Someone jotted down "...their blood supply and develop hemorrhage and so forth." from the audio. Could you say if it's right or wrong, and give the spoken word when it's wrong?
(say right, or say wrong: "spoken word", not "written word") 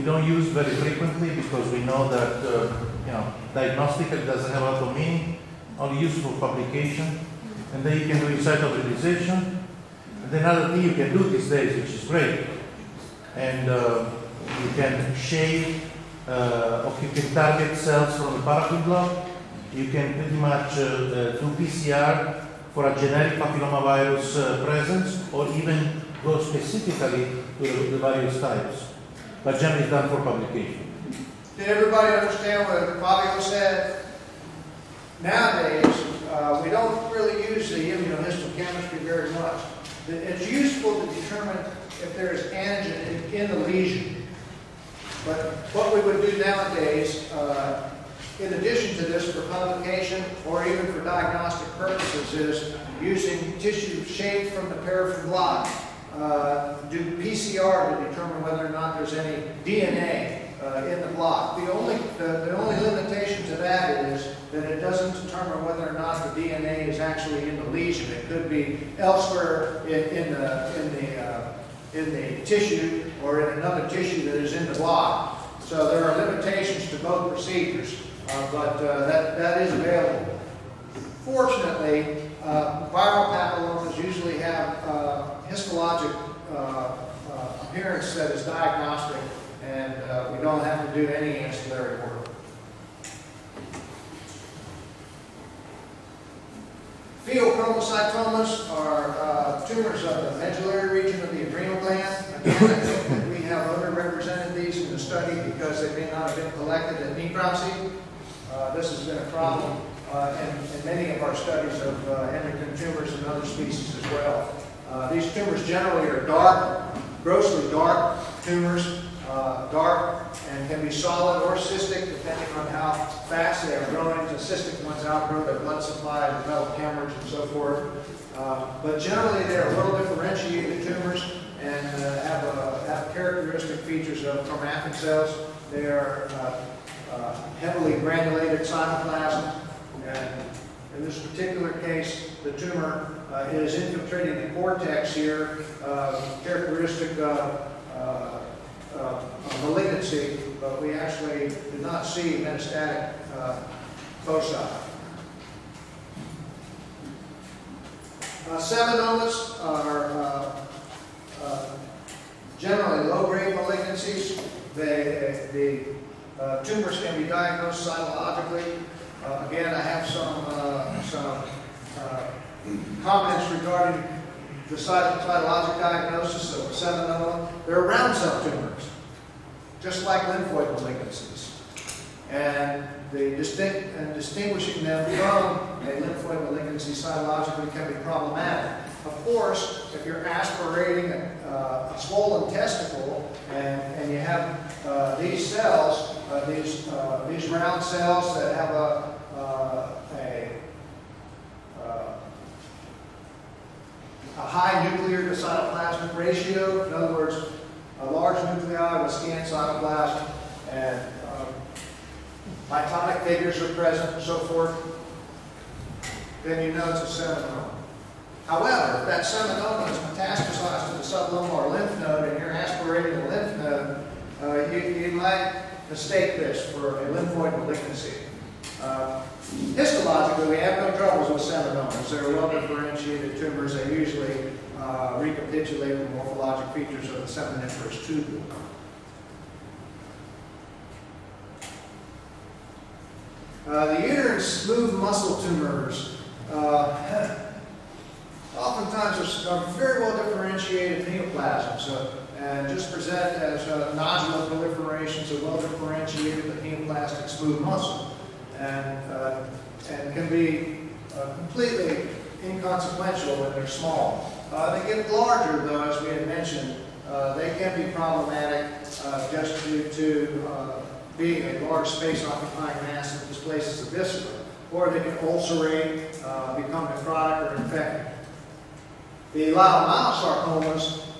right.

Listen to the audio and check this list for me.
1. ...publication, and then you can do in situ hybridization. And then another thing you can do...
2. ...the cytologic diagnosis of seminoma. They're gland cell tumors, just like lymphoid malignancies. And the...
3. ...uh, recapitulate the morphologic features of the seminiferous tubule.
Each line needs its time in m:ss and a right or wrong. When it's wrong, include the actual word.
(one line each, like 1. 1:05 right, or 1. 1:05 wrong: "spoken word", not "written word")
1. 0:06 right
2. 2:54 wrong: "round", not "gland"
3. 3:54 right.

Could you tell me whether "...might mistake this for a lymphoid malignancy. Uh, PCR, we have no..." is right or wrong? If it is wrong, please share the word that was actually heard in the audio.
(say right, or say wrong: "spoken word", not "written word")
wrong: "Histologically", not "PCR".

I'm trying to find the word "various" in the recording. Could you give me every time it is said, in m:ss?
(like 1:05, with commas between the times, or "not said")
0:27.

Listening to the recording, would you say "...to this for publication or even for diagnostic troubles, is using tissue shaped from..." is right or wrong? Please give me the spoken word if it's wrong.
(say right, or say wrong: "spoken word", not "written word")
wrong: "purposes", not "troubles".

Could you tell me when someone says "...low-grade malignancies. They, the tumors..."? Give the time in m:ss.
2:43.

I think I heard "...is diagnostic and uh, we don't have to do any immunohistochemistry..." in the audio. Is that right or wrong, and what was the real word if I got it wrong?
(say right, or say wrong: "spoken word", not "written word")
wrong: "ancillary", not "immunohistochemistry".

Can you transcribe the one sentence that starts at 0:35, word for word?
Nowadays, uh, we don't really use the immunohistochemistry very much.